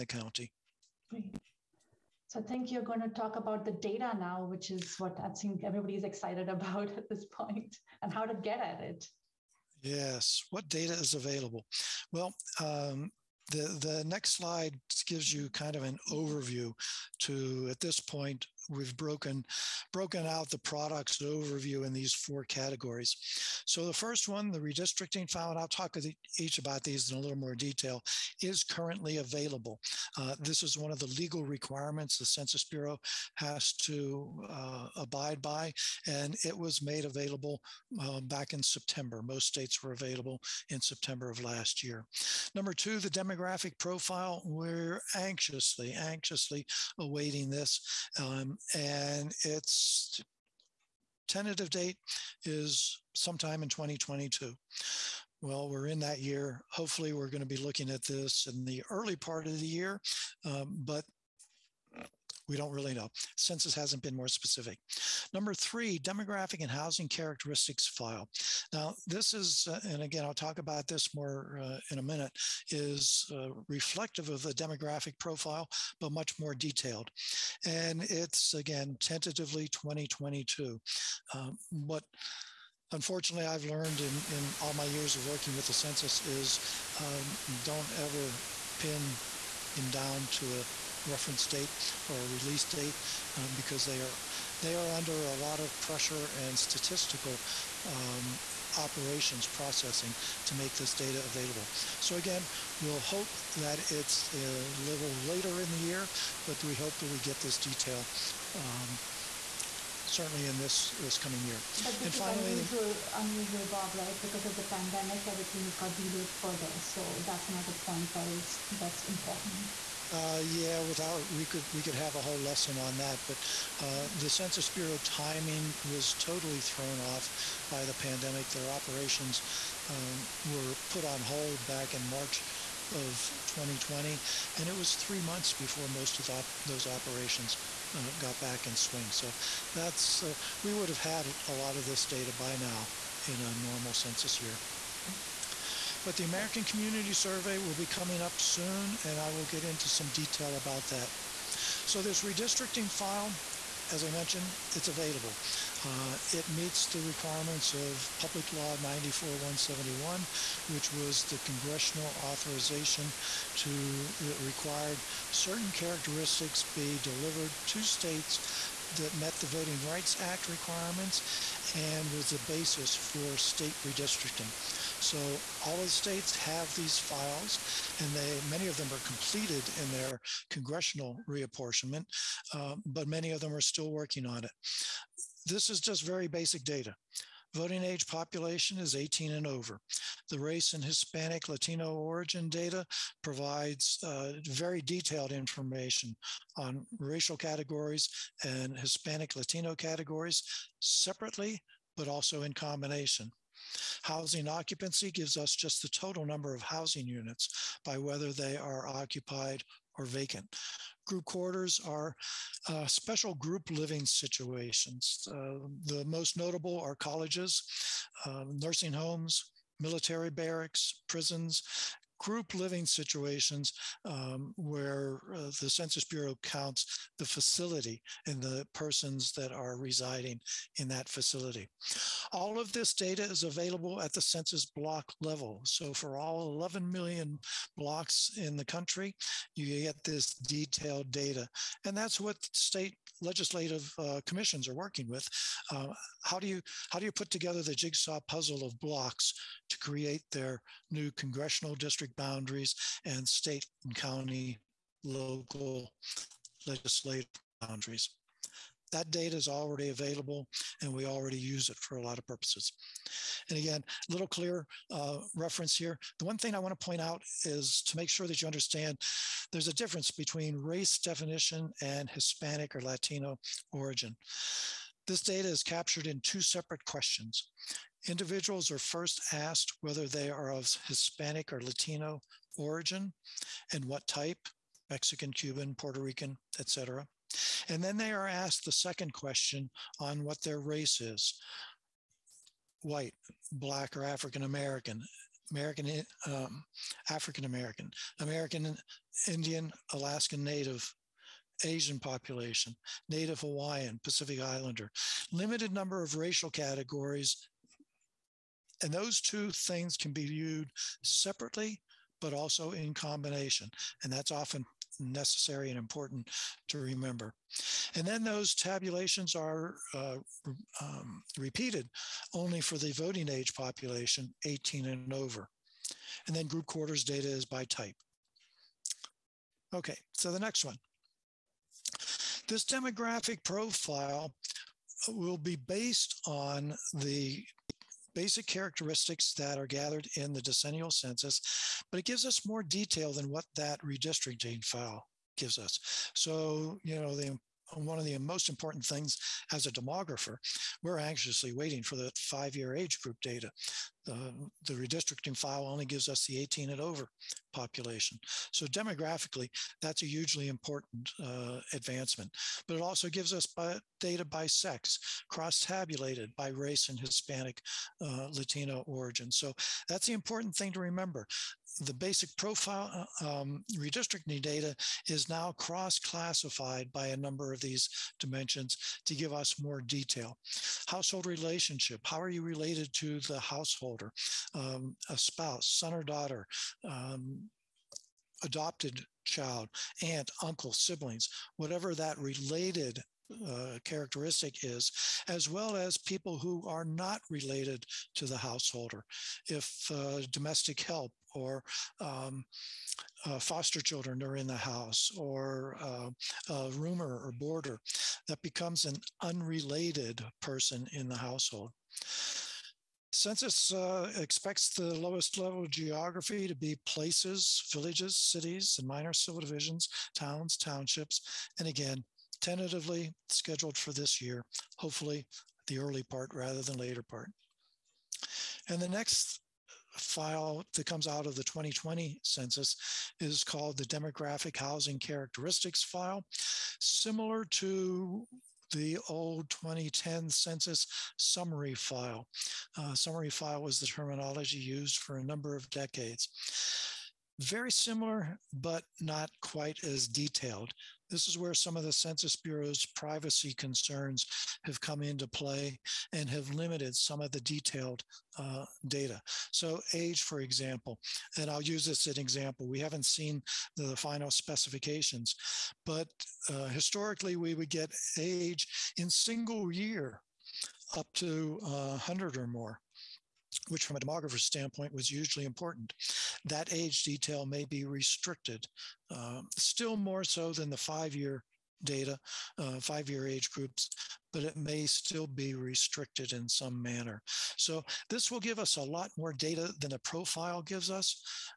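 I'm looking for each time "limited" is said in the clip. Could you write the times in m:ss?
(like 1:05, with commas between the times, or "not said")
5:05, 7:36.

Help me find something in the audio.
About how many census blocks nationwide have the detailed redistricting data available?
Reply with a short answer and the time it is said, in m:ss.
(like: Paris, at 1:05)
11 million, at 3:56.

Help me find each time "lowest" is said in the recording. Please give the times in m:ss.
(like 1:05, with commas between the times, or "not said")
6:54.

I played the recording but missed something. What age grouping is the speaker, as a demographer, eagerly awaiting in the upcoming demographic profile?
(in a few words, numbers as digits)
Five year age groups.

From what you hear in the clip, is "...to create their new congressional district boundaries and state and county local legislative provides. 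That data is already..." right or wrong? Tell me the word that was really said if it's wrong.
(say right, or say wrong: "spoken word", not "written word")
wrong: "boundaries", not "provides".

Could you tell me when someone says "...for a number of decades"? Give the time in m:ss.
7:24.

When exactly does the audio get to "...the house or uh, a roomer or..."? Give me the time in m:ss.
6:44.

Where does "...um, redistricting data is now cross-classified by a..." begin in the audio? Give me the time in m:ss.
6:13.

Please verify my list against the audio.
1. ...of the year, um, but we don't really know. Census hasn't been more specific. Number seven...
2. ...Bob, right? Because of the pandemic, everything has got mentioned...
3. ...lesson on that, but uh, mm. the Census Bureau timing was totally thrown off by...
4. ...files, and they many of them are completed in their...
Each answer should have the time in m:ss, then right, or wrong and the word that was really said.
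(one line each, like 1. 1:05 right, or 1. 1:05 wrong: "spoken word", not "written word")
1. 0:59 wrong: "three", not "seven"
2. 1:53 wrong: "delayed", not "mentioned"
3. 2:02 right
4. 2:56 right.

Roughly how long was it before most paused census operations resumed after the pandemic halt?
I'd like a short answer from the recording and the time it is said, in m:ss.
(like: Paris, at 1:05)
Three months, at 2:14.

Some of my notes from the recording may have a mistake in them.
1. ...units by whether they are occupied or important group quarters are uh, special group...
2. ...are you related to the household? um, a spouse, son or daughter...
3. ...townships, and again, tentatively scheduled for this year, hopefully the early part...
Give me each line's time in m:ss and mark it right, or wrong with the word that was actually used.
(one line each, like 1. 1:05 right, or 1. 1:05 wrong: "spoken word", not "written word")
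1. 3:27 wrong: "vacant", not "important"
2. 6:22 right
3. 7:00 right.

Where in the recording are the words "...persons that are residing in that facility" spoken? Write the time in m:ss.
3:48.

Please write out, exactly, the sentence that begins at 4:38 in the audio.
Individuals are first asked whether they are of Hispanic or Latino origin and what type Mexican, Cuban, Puerto Rican, etc.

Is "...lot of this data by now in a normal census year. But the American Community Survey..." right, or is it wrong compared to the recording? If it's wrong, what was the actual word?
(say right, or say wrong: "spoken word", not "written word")
right.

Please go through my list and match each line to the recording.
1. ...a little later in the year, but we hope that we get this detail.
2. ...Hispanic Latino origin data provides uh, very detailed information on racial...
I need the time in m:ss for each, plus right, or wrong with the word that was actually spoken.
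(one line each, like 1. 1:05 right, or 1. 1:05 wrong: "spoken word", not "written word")
1. 1:44 right
2. 3:10 right.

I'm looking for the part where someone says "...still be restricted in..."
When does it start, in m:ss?
8:04.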